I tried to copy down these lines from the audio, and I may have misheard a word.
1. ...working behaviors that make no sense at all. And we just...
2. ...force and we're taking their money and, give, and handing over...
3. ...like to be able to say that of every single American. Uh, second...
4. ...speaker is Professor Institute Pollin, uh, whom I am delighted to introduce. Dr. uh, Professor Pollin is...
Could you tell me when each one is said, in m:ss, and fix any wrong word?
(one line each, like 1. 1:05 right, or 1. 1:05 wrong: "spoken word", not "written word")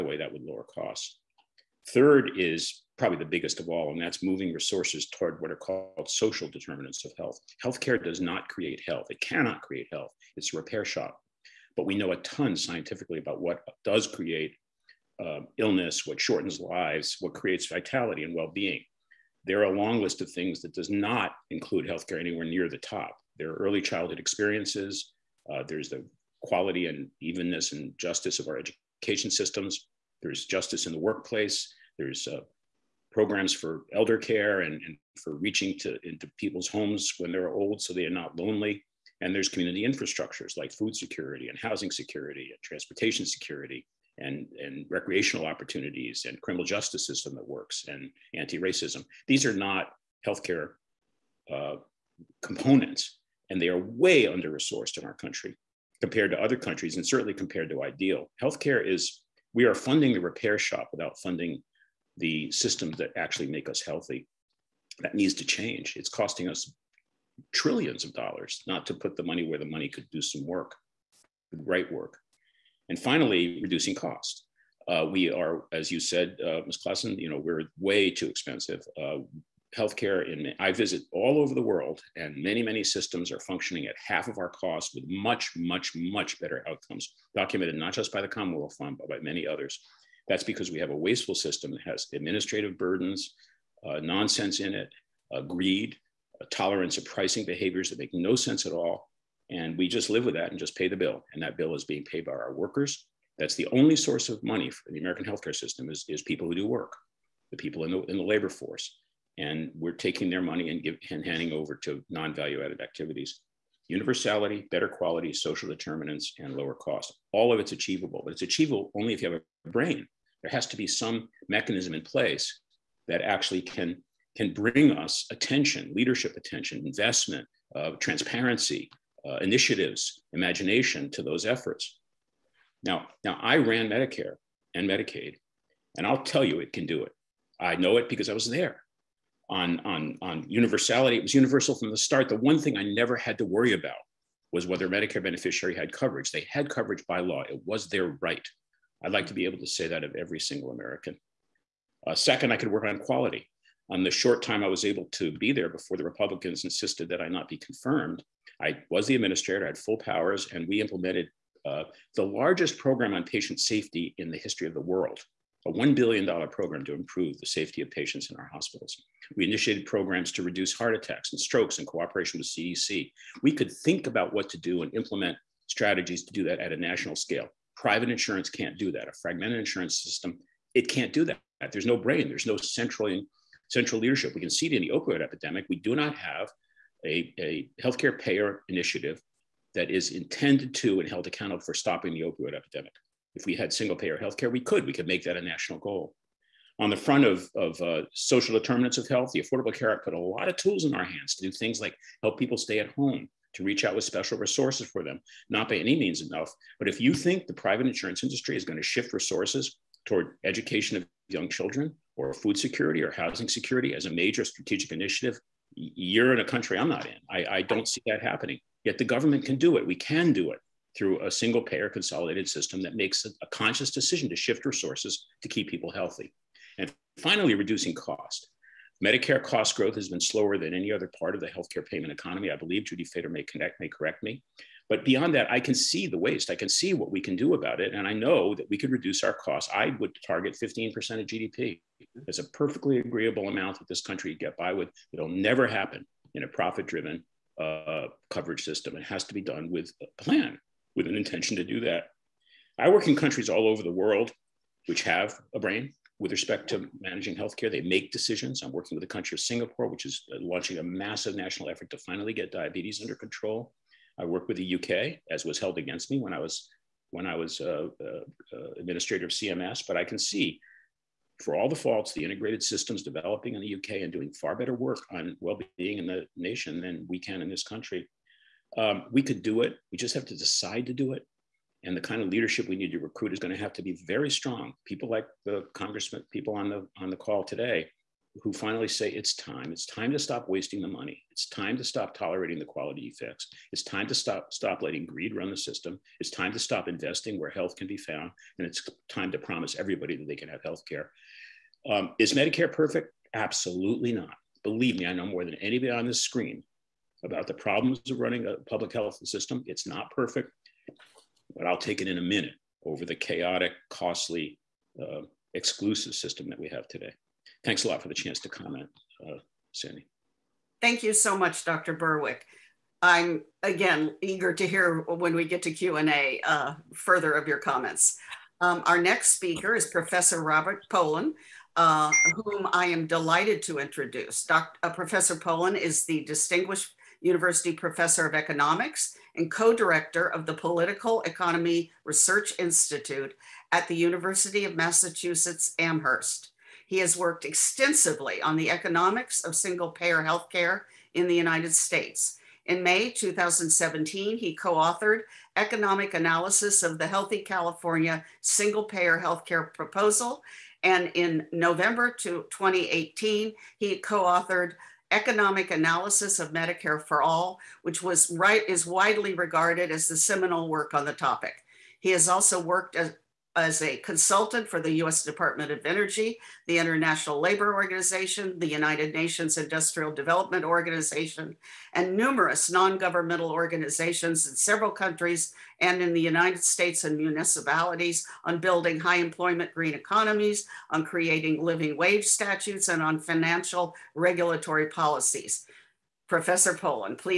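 1. 1:37 wrong: "pricing", not "working"
2. 1:48 right
3. 2:29 right
4. 5:29 wrong: "Robert", not "Institute".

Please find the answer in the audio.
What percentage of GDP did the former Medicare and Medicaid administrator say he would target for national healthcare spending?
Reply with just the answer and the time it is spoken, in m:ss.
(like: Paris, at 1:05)
15%, at 4:00.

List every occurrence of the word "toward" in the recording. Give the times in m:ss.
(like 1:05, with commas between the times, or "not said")
0:05, 3:30.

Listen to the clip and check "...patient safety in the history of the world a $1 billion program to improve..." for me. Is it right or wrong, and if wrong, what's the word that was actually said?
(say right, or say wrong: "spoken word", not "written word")
right.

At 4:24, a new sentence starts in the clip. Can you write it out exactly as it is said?
I work with the UK, as was held against me when I was when I was uh, uh, uh administrator of CMS.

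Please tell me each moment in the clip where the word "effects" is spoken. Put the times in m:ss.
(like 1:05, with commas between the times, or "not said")
4:53.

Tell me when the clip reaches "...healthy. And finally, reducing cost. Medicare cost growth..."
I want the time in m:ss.
3:45.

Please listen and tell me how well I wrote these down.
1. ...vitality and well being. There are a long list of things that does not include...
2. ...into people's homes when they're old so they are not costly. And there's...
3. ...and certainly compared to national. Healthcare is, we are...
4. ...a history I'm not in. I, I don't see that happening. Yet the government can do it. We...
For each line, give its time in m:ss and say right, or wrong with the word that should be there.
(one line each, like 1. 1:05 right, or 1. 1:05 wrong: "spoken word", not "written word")
1. 0:17 right
2. 0:36 wrong: "lonely", not "costly"
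3. 0:56 wrong: "ideal", not "national"
4. 3:36 wrong: "country", not "history".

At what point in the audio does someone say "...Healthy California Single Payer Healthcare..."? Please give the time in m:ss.
5:57.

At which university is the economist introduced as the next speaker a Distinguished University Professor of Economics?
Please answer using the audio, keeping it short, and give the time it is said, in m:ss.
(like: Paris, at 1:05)
University of Massachusetts Amherst, at 5:43.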